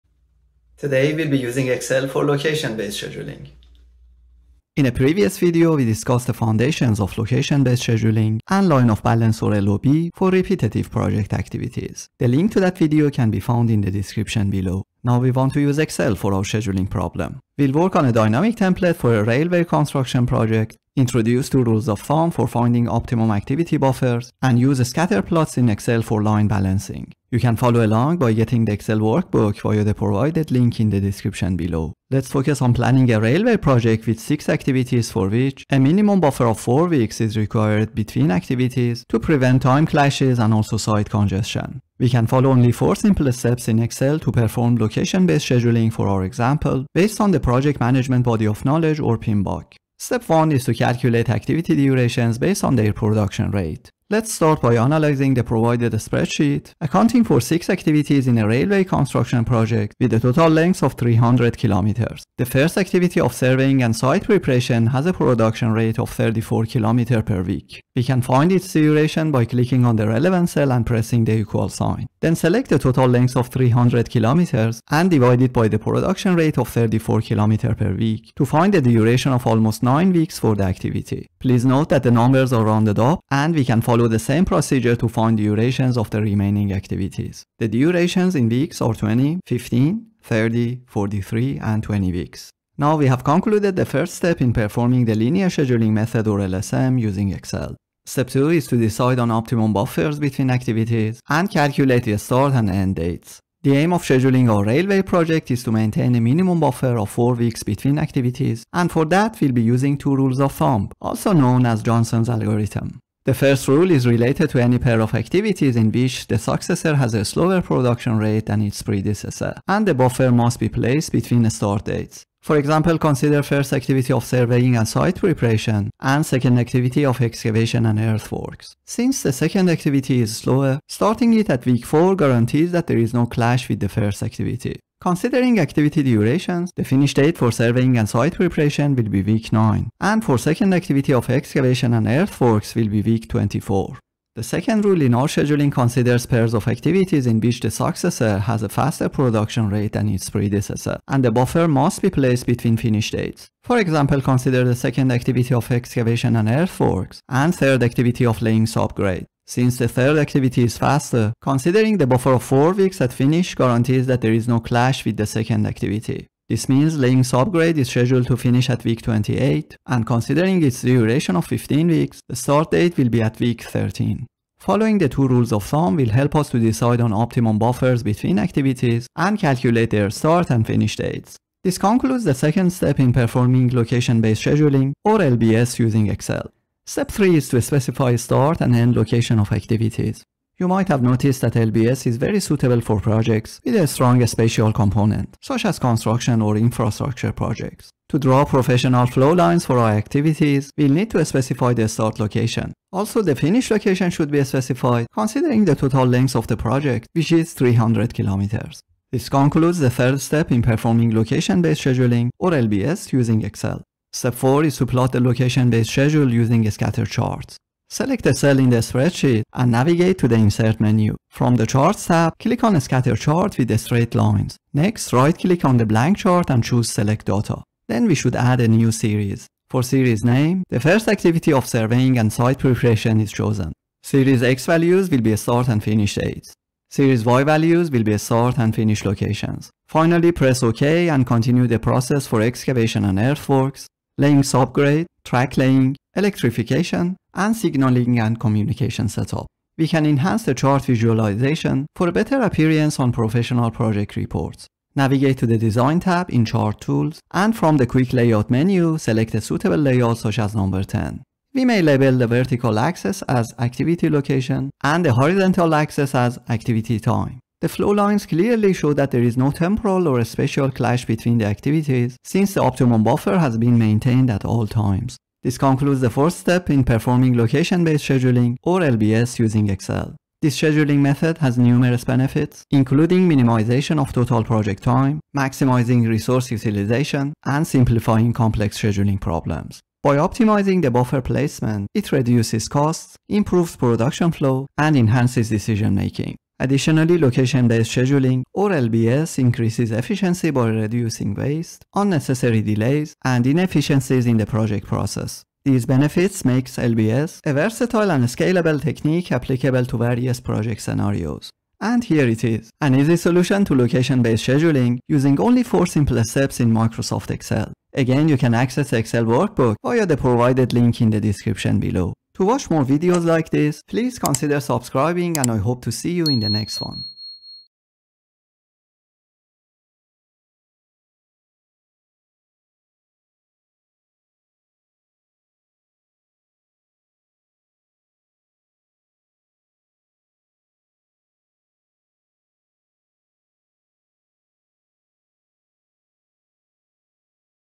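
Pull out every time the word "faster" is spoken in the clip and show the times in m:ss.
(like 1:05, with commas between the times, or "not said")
2:28, 2:40.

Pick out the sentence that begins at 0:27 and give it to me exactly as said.
You can follow along by getting the Excel workbook via the provided link in the description below.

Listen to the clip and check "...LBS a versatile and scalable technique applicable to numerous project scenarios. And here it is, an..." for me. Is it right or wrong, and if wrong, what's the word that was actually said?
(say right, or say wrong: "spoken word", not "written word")
wrong: "various", not "numerous".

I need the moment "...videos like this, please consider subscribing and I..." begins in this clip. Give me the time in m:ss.
5:22.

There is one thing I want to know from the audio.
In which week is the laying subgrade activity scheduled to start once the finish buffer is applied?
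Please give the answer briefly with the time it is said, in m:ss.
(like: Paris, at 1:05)
13, at 2:53.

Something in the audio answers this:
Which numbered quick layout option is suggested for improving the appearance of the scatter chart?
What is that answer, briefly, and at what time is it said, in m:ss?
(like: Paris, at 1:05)
10, at 4:20.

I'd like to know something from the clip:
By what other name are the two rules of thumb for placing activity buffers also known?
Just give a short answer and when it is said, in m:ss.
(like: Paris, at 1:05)
Johnson's algorithm, at 1:51.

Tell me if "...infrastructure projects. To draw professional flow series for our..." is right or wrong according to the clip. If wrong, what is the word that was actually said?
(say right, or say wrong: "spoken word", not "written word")
wrong: "lines", not "series".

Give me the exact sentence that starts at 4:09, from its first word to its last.
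We can enhance the chart visualization for a better appearance on professional project reports.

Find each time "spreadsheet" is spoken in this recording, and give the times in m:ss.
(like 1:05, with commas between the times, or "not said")
0:55, 3:38.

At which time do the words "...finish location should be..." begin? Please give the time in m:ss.
3:23.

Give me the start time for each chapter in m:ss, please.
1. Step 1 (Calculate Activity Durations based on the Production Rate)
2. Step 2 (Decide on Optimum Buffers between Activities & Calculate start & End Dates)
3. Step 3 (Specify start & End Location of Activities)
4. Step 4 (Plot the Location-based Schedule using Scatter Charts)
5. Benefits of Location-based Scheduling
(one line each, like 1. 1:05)
1. 0:49
2. 1:38
3. 3:06
4. 3:33
5. 4:41.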